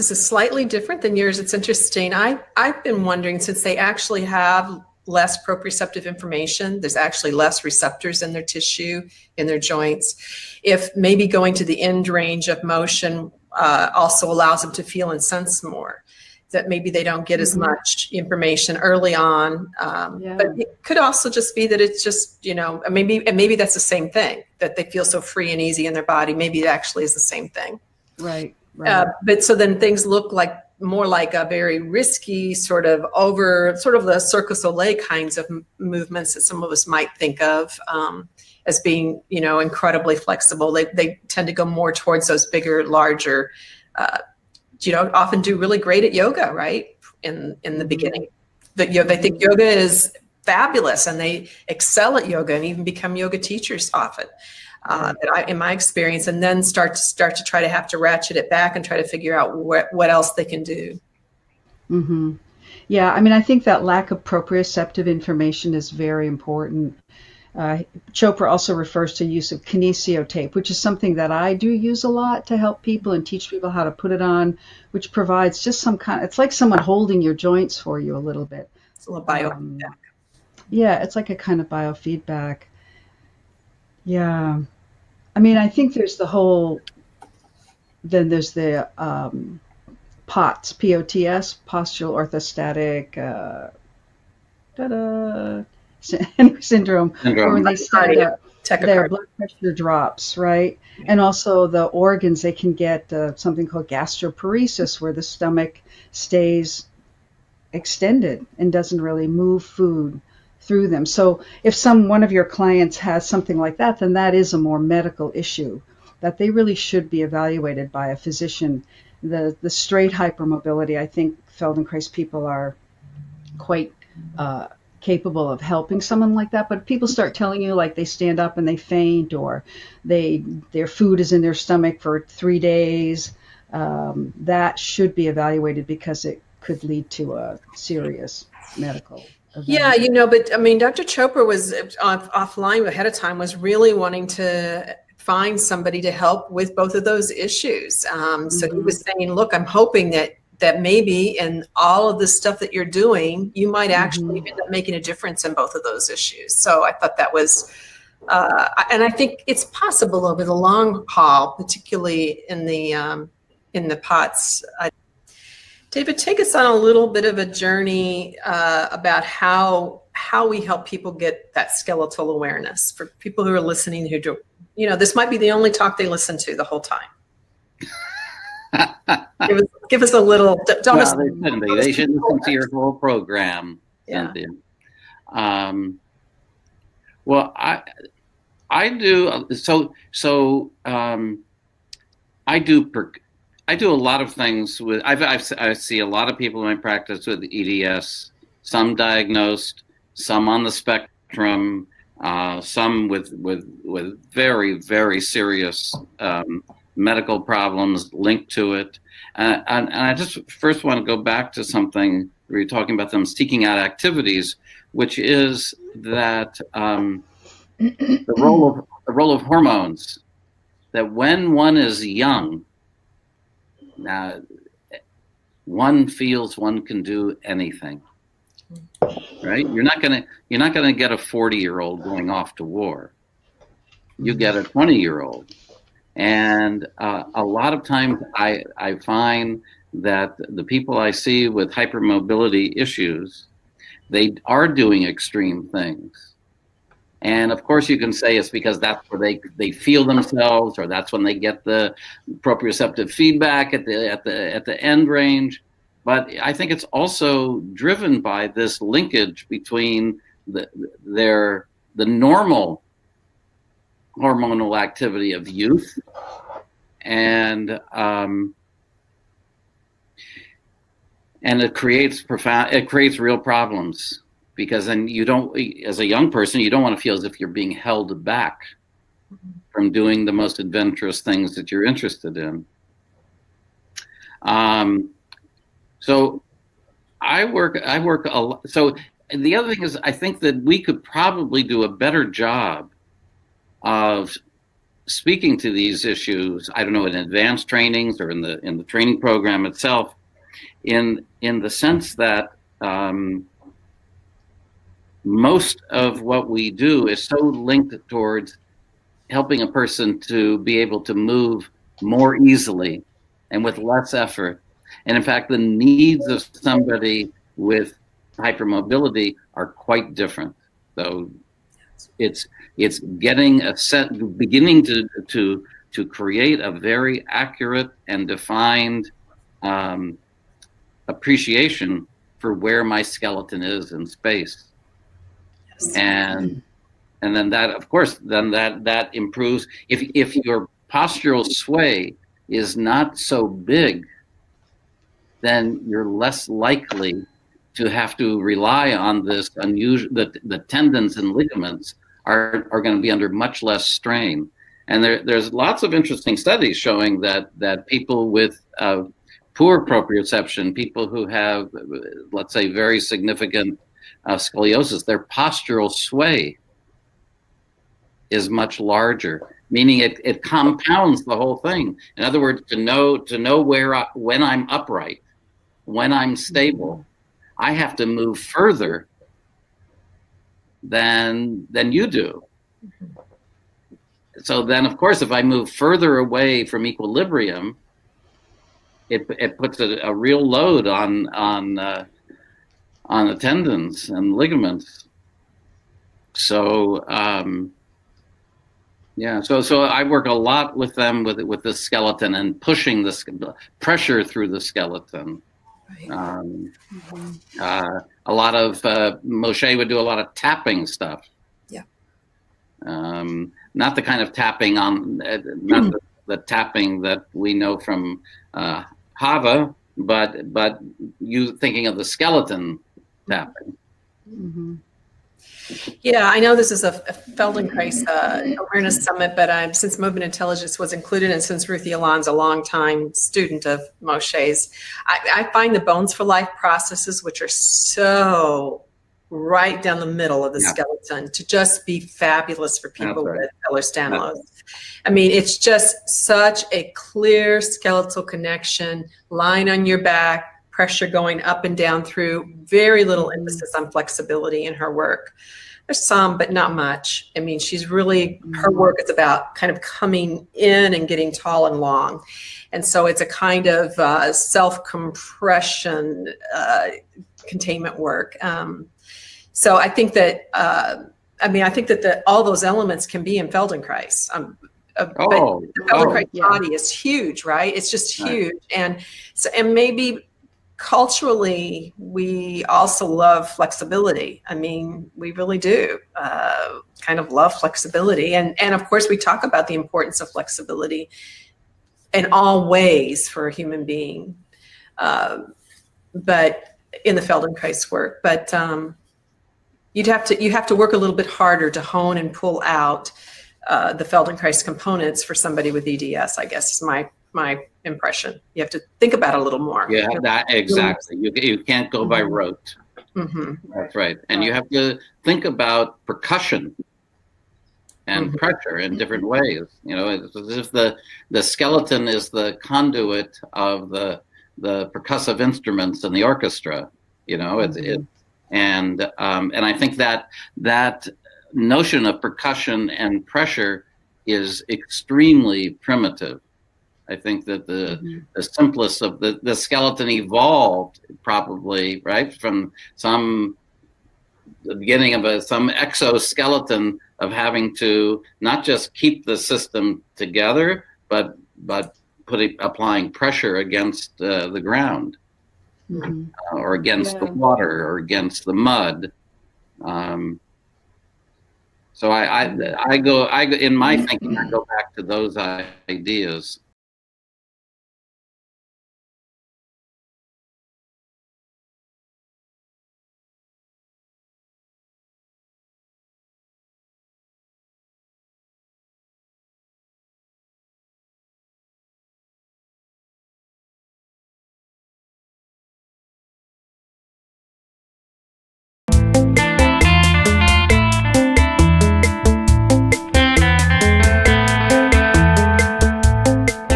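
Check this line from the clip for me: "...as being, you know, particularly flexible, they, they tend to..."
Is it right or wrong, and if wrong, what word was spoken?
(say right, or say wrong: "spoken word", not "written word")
wrong: "incredibly", not "particularly".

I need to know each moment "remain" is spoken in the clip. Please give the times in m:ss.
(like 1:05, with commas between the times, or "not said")
not said.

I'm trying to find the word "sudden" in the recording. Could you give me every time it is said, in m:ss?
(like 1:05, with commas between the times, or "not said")
not said.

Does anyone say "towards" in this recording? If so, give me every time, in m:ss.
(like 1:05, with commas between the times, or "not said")
0:41, 5:08.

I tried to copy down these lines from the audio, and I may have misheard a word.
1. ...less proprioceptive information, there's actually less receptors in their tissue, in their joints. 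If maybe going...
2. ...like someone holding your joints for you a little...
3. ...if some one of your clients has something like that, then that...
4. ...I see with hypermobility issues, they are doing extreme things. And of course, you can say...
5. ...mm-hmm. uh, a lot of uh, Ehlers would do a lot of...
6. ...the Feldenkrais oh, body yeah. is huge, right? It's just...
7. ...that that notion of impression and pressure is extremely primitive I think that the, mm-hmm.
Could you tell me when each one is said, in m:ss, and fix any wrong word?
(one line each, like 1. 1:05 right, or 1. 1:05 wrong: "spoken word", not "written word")
1. 0:05 right
2. 1:16 right
3. 1:51 right
4. 4:00 right
5. 6:46 wrong: "Moshe", not "Ehlers"
6. 7:55 right
7. 8:50 wrong: "percussion", not "impression".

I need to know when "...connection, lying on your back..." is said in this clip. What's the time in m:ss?
7:28.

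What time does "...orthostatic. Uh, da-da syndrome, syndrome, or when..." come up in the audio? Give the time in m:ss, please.
1:32.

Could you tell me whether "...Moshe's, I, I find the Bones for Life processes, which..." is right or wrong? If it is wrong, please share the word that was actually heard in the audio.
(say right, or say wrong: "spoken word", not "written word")
right.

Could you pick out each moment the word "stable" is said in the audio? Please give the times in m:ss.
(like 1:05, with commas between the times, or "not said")
6:16.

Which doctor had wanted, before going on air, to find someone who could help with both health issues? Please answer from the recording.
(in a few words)
Dr Chopra.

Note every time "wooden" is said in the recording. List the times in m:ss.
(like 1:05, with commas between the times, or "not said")
not said.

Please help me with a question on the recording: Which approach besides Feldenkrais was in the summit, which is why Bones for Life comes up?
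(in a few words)
Movement Intelligence.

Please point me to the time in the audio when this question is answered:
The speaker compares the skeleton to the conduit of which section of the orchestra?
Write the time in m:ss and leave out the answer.
8:44.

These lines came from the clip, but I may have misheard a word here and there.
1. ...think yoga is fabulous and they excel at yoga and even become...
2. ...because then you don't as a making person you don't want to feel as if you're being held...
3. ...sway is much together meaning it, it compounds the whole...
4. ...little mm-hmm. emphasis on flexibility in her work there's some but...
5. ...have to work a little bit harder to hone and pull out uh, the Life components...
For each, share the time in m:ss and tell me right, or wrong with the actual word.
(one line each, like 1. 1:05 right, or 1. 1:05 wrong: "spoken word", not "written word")
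1. 0:49 right
2. 4:34 wrong: "young", not "making"
3. 6:05 wrong: "larger", not "together"
4. 7:33 right
5. 8:20 wrong: "Feldenkrais", not "Life".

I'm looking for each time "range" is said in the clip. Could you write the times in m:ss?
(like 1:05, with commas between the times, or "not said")
0:12, 4:15.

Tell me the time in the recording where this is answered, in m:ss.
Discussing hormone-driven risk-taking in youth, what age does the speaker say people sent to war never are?
3:51.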